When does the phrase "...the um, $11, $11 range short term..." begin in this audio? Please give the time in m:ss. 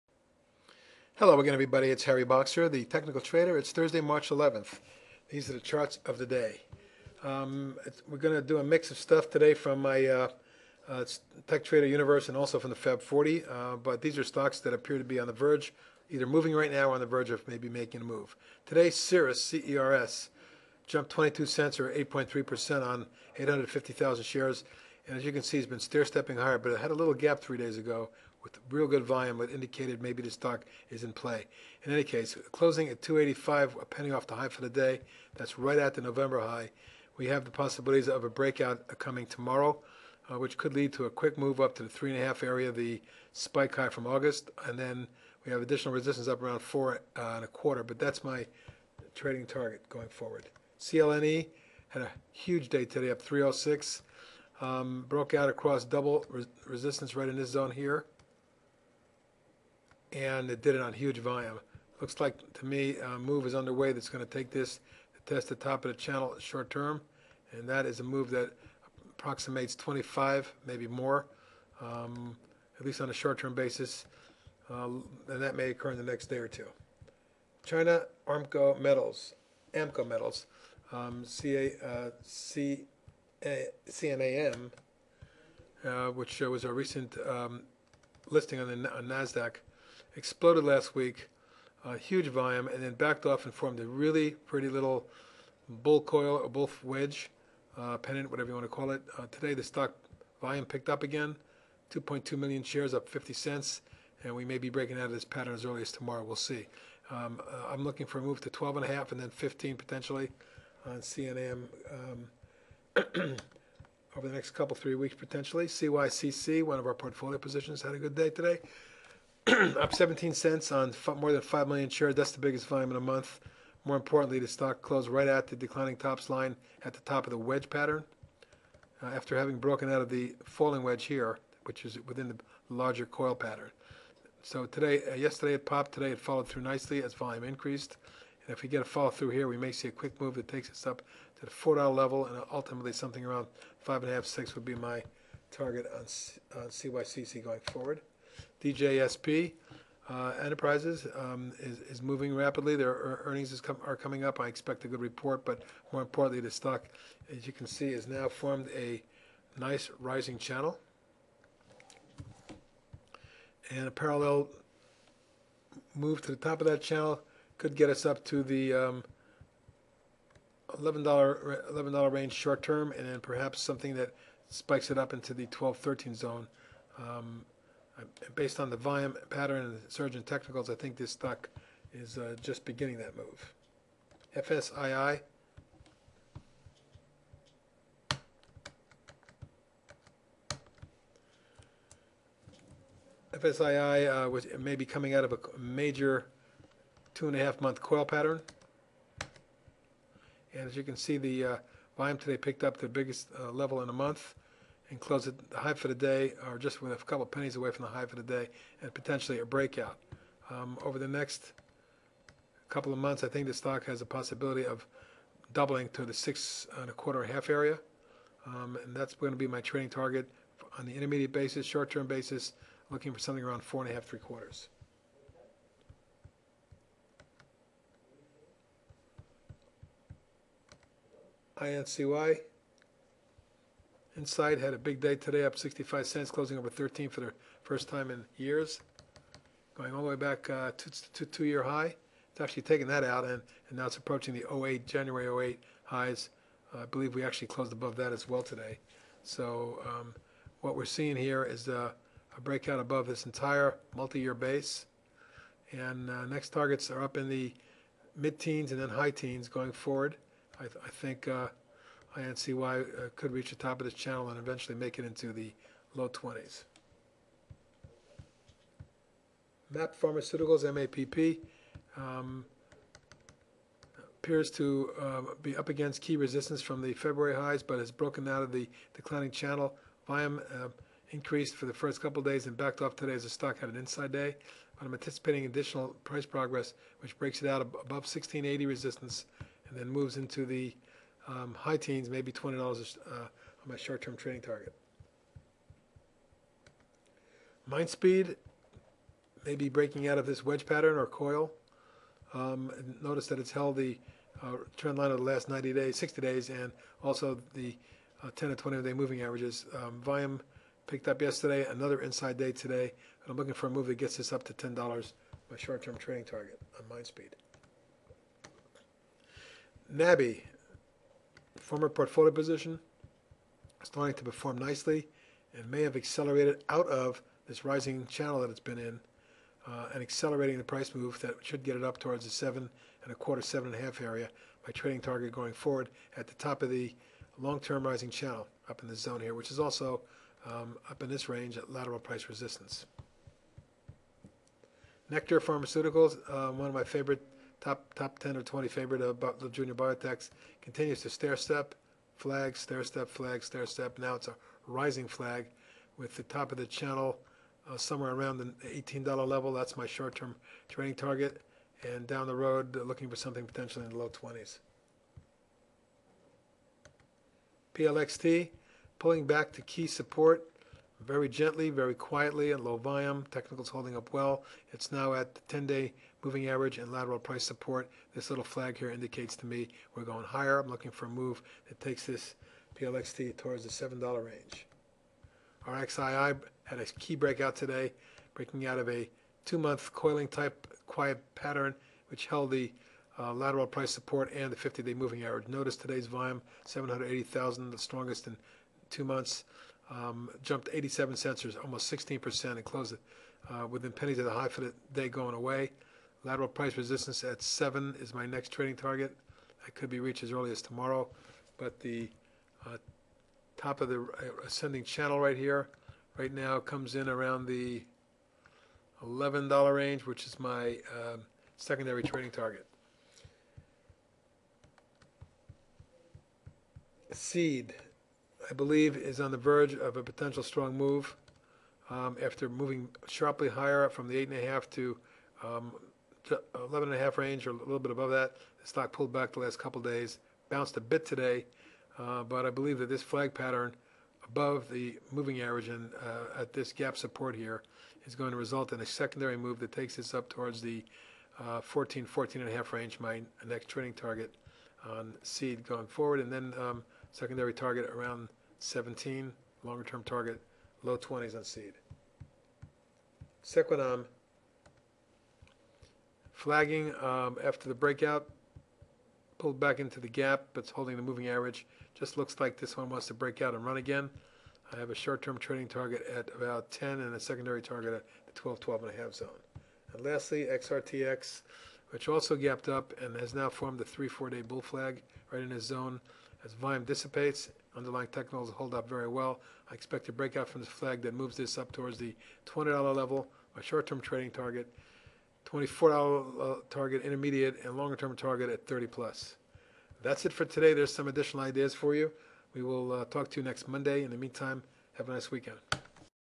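2:48.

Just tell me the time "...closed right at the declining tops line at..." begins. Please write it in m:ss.
2:04.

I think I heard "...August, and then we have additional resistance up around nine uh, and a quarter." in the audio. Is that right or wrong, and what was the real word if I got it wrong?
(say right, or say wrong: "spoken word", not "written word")
wrong: "four", not "nine".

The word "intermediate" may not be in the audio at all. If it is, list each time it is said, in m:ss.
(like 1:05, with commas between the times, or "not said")
3:40, 8:17.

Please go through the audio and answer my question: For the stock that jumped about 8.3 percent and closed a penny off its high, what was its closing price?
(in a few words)
2.85.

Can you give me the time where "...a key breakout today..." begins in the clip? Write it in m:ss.
6:26.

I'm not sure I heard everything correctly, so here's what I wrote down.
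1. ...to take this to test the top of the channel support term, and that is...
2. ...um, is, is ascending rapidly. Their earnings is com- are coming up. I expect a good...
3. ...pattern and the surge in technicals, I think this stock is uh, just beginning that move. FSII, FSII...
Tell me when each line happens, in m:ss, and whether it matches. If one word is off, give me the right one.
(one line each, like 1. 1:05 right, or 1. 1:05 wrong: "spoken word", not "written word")
1. 1:04 wrong: "short", not "support"
2. 2:31 wrong: "moving", not "ascending"
3. 2:59 right.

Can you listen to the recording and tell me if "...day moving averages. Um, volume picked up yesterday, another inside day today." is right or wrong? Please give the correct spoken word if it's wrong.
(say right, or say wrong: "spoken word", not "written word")
right.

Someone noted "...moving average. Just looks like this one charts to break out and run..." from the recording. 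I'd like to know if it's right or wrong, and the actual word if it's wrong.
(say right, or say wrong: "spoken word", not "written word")
wrong: "wants", not "charts".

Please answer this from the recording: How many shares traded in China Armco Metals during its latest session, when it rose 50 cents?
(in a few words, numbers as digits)
2.2 million.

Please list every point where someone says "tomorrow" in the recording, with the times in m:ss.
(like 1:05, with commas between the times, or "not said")
0:39, 1:45, 6:50.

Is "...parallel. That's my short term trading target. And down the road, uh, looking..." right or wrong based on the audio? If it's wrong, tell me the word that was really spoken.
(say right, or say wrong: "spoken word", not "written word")
wrong: "level", not "parallel".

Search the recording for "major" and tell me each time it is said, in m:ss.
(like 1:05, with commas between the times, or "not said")
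3:15.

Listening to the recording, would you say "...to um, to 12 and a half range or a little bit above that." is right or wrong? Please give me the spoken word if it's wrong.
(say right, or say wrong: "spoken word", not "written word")
wrong: "11", not "12".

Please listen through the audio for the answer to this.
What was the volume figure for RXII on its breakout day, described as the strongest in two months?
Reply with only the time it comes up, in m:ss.
6:36.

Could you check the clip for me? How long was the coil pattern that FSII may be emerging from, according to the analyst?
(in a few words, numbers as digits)
2.5 months.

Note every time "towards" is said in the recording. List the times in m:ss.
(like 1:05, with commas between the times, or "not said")
5:31, 6:23, 7:30, 8:11.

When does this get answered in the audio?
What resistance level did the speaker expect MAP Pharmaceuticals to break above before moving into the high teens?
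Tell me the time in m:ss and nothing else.
4:47.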